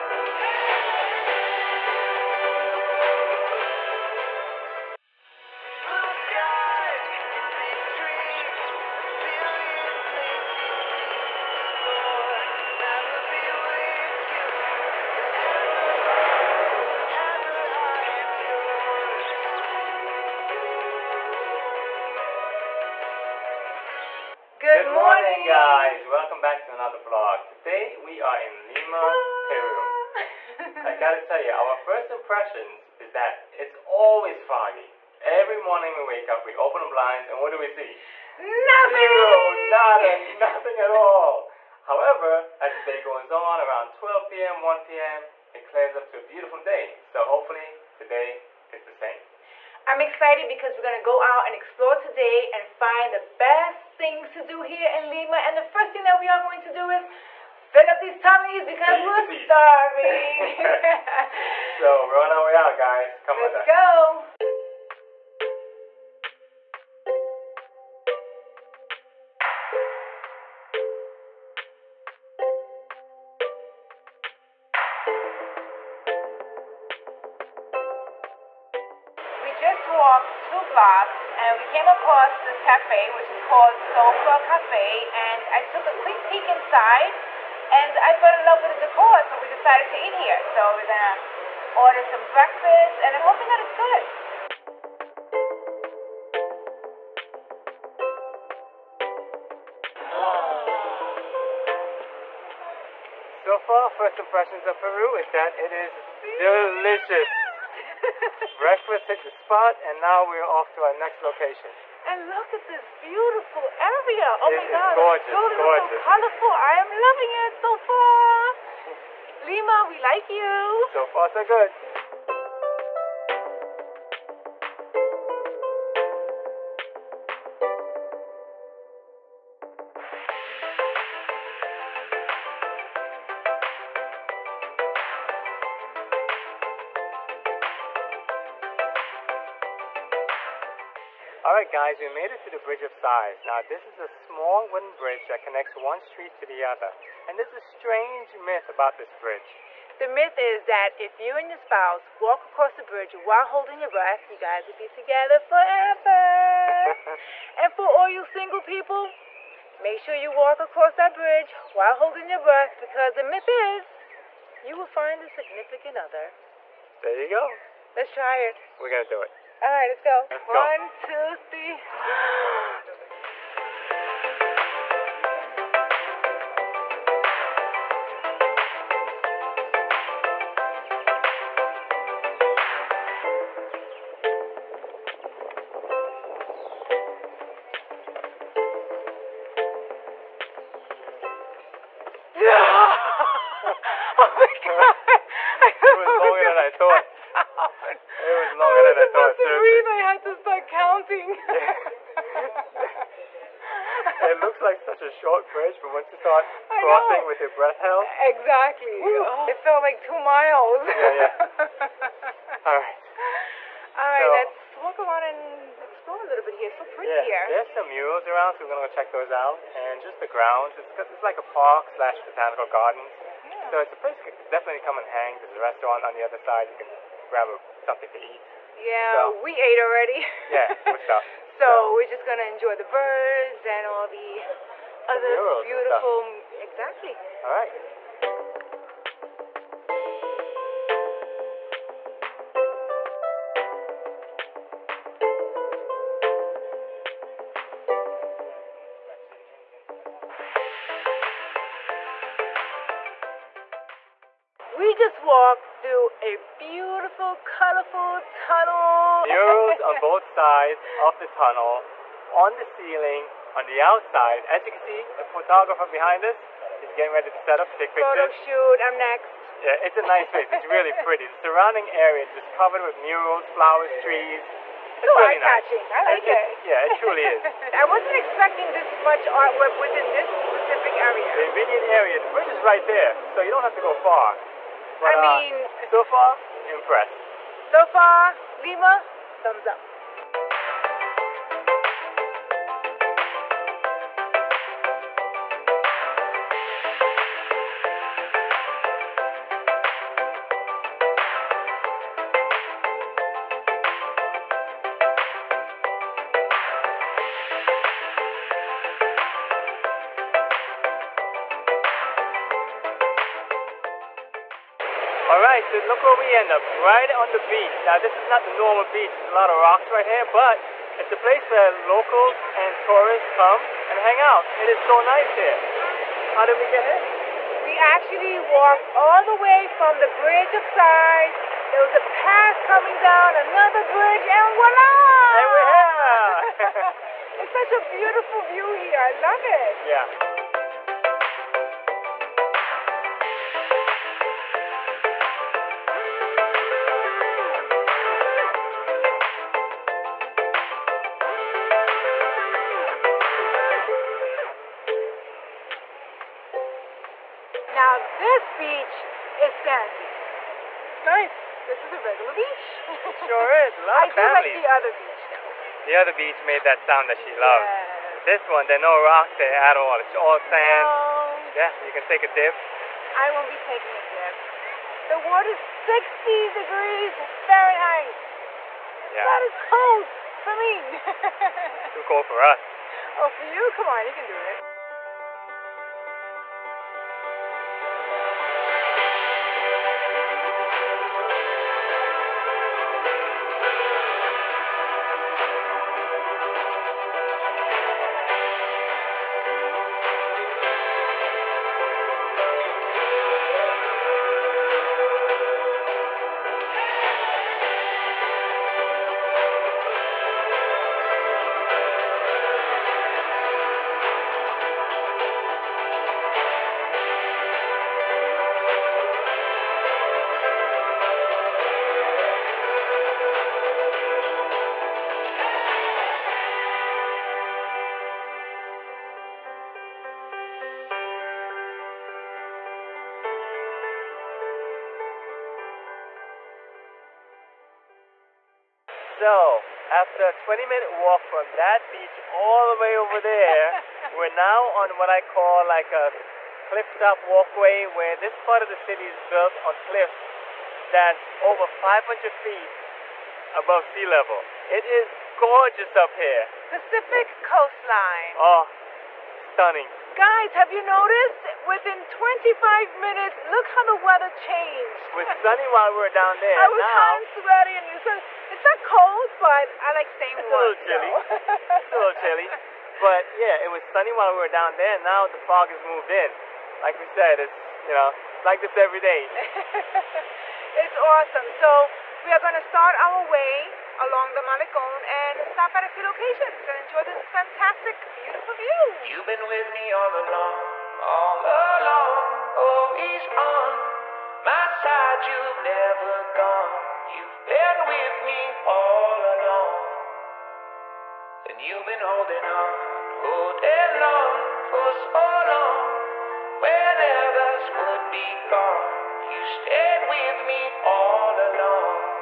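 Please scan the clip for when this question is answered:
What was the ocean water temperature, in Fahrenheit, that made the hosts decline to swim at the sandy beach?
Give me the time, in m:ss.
6:15.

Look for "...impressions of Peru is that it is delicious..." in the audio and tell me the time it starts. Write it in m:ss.
1:44.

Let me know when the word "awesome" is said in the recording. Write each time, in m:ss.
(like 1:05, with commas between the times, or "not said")
8:00.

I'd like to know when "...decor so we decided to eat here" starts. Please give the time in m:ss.
1:28.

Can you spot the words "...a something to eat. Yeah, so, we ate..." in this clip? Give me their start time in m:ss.
3:47.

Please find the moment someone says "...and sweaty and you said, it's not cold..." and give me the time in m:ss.
7:47.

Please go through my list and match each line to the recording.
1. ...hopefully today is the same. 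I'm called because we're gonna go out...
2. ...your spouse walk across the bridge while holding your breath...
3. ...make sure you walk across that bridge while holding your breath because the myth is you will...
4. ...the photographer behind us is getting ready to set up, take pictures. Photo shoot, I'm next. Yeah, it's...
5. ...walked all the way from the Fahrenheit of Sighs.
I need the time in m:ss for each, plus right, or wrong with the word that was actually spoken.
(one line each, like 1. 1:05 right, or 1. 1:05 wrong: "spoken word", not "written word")
1. 0:47 wrong: "excited", not "called"
2. 2:31 right
3. 2:39 right
4. 4:25 right
5. 5:28 wrong: "Bridge", not "Fahrenheit".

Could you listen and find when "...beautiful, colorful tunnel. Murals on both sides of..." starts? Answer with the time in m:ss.
4:16.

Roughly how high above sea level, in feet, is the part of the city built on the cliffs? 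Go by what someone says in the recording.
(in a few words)
over 500 feet.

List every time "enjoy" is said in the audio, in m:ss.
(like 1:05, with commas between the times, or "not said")
3:52, 8:06.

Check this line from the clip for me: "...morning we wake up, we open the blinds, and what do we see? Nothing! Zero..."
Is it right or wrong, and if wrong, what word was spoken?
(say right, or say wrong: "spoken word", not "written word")
right.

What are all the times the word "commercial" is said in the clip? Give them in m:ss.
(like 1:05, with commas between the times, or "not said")
not said.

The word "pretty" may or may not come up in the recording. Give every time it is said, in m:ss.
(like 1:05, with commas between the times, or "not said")
3:36, 4:31.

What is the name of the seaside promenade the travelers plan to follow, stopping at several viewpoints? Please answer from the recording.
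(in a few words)
Malecon.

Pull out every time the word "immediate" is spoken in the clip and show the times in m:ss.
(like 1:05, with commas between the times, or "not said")
4:41.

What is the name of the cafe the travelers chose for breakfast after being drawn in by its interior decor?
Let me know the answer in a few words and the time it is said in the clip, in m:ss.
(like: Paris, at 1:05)
Sofa Cafe, at 1:23.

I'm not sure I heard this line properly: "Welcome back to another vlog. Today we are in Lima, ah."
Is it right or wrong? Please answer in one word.
right.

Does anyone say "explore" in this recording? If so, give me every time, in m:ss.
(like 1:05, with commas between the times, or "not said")
0:51, 3:35.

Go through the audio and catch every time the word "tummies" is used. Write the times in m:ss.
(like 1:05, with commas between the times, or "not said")
0:58.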